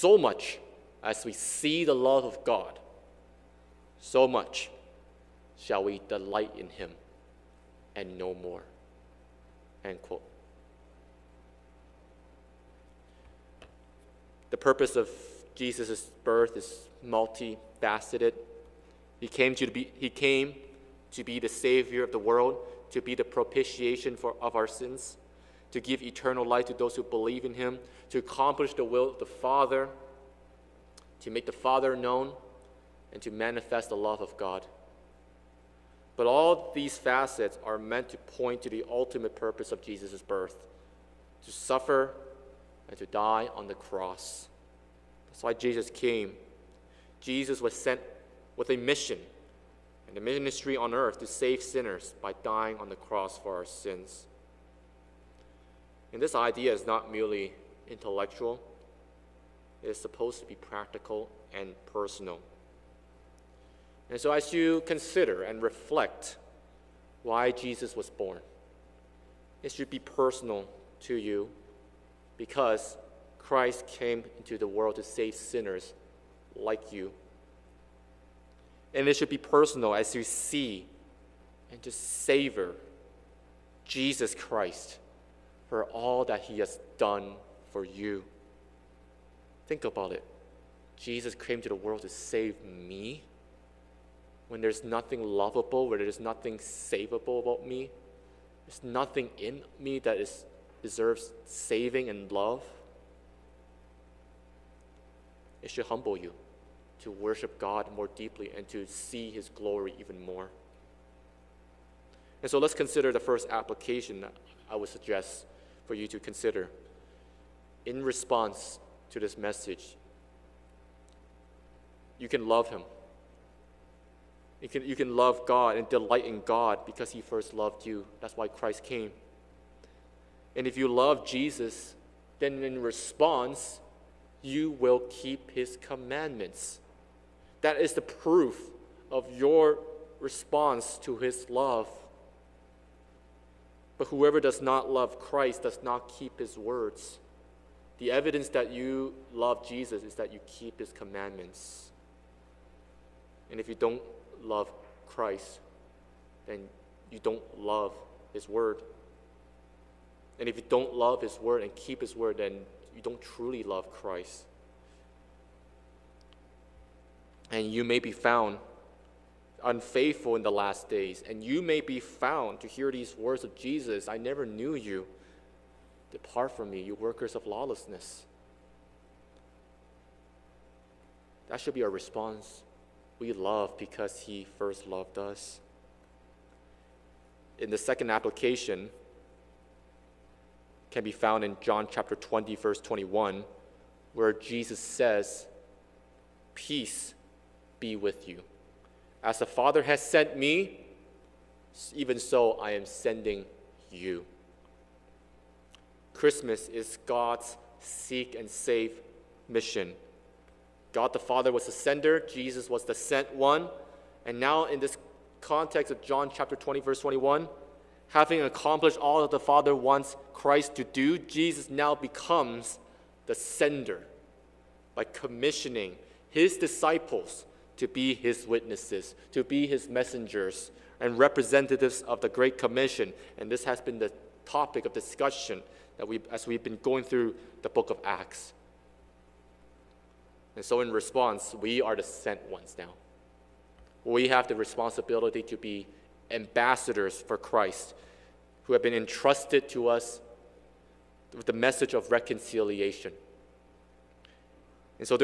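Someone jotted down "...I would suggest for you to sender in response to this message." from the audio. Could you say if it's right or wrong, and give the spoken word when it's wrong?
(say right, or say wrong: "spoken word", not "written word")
wrong: "consider", not "sender".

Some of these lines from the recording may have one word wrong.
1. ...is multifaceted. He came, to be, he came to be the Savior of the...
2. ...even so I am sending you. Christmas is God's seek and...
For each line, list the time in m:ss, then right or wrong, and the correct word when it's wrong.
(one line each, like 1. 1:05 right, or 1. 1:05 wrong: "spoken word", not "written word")
1. 0:16 right
2. 3:21 right.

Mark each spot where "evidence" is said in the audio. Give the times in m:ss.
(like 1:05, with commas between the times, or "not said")
2:28.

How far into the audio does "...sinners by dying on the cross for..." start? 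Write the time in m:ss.
0:51.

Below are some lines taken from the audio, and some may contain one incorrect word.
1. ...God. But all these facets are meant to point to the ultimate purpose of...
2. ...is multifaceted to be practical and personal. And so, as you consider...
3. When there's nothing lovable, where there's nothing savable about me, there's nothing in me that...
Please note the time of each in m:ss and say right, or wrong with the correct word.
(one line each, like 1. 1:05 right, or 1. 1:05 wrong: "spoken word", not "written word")
1. 0:34 right
2. 0:59 wrong: "supposed", not "multifaceted"
3. 1:34 right.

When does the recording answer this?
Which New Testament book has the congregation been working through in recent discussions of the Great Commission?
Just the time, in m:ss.
3:57.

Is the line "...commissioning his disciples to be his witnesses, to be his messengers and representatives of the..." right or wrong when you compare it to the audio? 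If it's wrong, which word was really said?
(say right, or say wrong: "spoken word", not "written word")
right.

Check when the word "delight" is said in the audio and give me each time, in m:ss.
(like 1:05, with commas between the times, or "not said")
0:06, 2:05.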